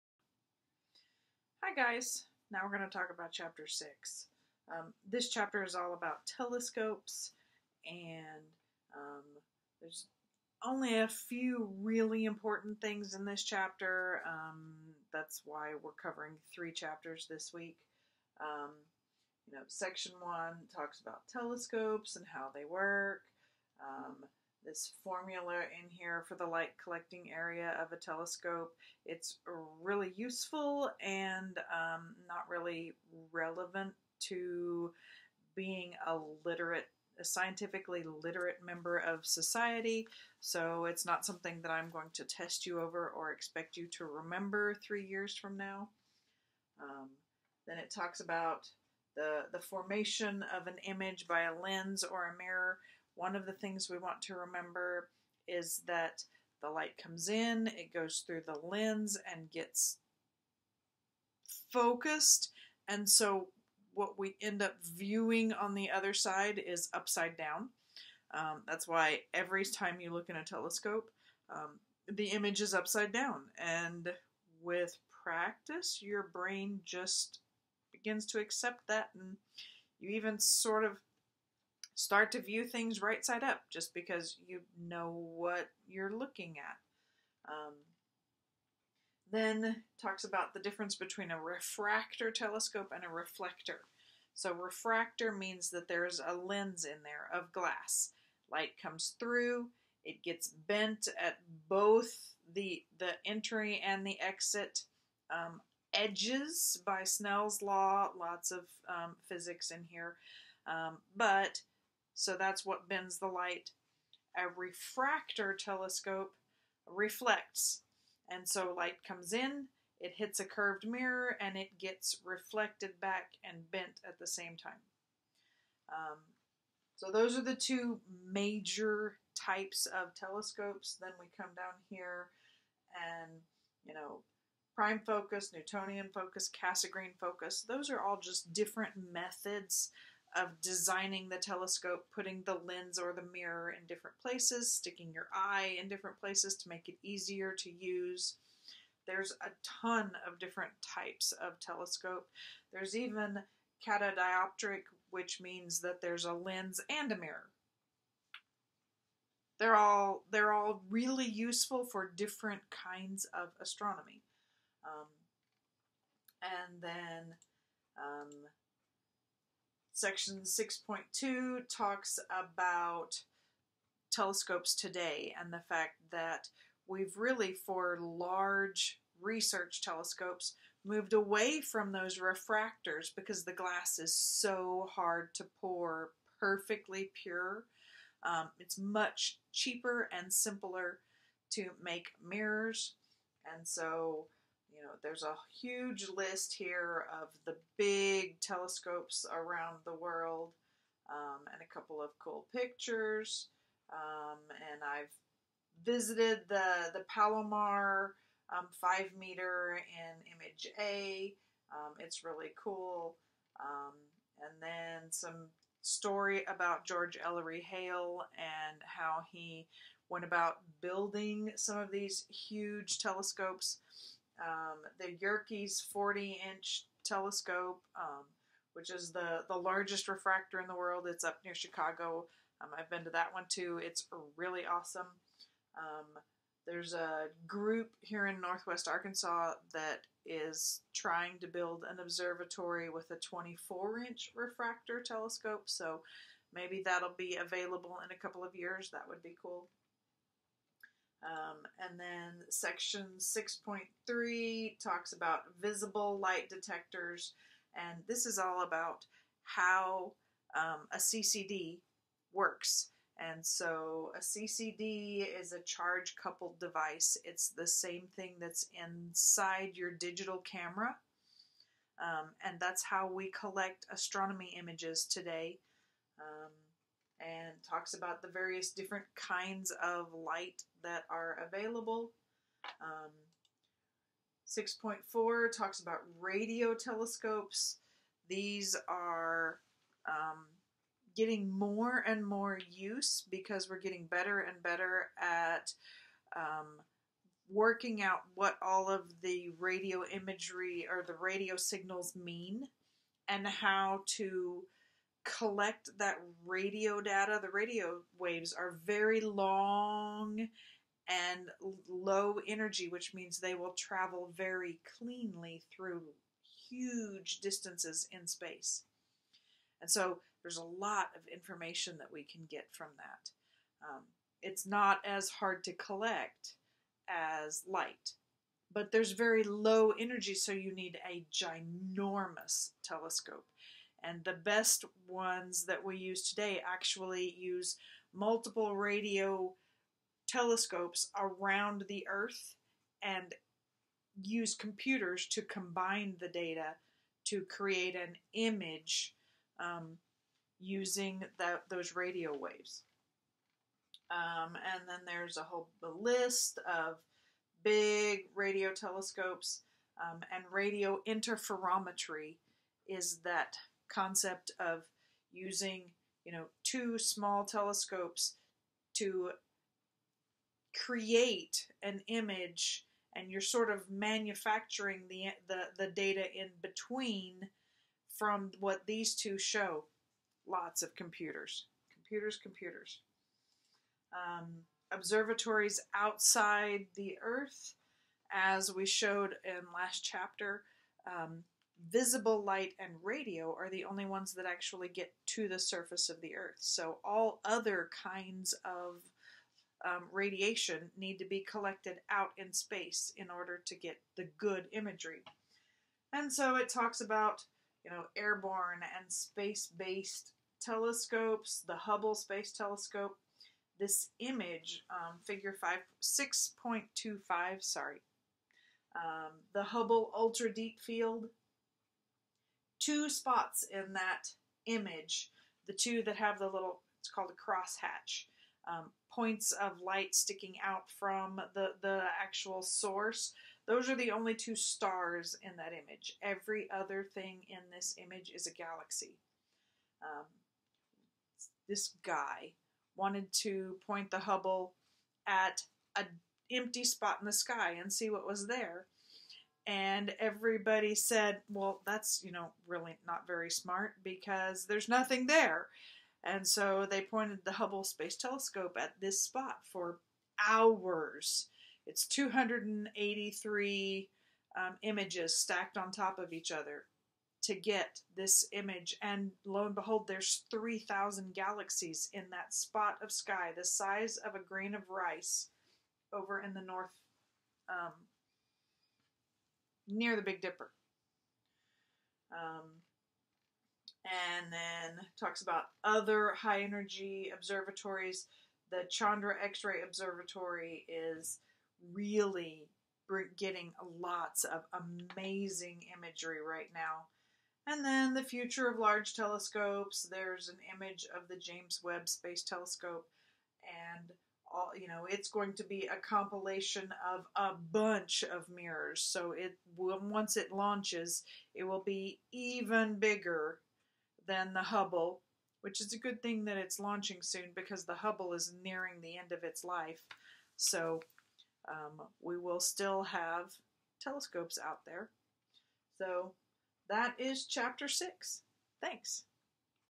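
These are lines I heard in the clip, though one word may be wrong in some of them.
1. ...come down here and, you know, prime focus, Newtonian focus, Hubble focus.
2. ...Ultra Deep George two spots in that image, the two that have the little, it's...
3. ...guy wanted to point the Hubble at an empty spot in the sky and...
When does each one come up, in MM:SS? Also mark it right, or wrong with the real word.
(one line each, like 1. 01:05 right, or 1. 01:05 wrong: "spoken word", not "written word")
1. 02:11 wrong: "Cassegrain", not "Hubble"
2. 07:00 wrong: "Field", not "George"
3. 07:22 right.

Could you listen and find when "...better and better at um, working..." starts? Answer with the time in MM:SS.
04:54.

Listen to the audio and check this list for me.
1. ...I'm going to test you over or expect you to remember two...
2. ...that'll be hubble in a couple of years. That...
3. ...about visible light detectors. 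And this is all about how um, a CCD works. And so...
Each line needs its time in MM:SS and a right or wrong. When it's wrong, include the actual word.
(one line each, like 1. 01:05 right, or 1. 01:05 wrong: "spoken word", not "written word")
1. 00:41 wrong: "three", not "two"
2. 04:06 wrong: "available", not "hubble"
3. 04:15 right.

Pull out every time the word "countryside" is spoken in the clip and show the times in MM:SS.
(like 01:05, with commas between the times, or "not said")
not said.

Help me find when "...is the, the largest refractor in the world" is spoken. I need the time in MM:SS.
03:48.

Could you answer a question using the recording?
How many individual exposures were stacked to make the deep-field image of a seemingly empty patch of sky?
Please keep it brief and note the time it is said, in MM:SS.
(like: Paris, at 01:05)
283, at 07:42.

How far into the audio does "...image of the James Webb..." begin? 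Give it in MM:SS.
08:20.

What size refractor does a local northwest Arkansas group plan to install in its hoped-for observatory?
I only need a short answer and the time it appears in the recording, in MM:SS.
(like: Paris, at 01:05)
24 inch, at 04:03.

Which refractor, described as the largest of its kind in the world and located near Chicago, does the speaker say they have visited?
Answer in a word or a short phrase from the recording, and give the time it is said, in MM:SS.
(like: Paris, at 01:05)
Yerkes 40 inch telescope, at 03:45.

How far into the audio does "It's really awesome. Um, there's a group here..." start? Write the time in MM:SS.
03:53.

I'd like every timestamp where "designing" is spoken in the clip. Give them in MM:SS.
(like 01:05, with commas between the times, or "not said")
02:20.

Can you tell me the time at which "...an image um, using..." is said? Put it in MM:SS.
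05:47.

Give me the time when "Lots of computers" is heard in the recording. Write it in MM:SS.
06:20.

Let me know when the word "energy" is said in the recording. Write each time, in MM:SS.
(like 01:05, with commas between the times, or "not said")
05:12, 05:29, 08:06.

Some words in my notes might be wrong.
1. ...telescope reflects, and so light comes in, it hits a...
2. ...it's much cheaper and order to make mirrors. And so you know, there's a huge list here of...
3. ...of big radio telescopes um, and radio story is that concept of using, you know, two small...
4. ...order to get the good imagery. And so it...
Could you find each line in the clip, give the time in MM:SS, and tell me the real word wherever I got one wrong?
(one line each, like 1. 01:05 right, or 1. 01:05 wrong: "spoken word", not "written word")
1. 01:55 right
2. 03:08 wrong: "simpler", not "order"
3. 05:56 wrong: "interferometry", not "story"
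4. 06:43 right.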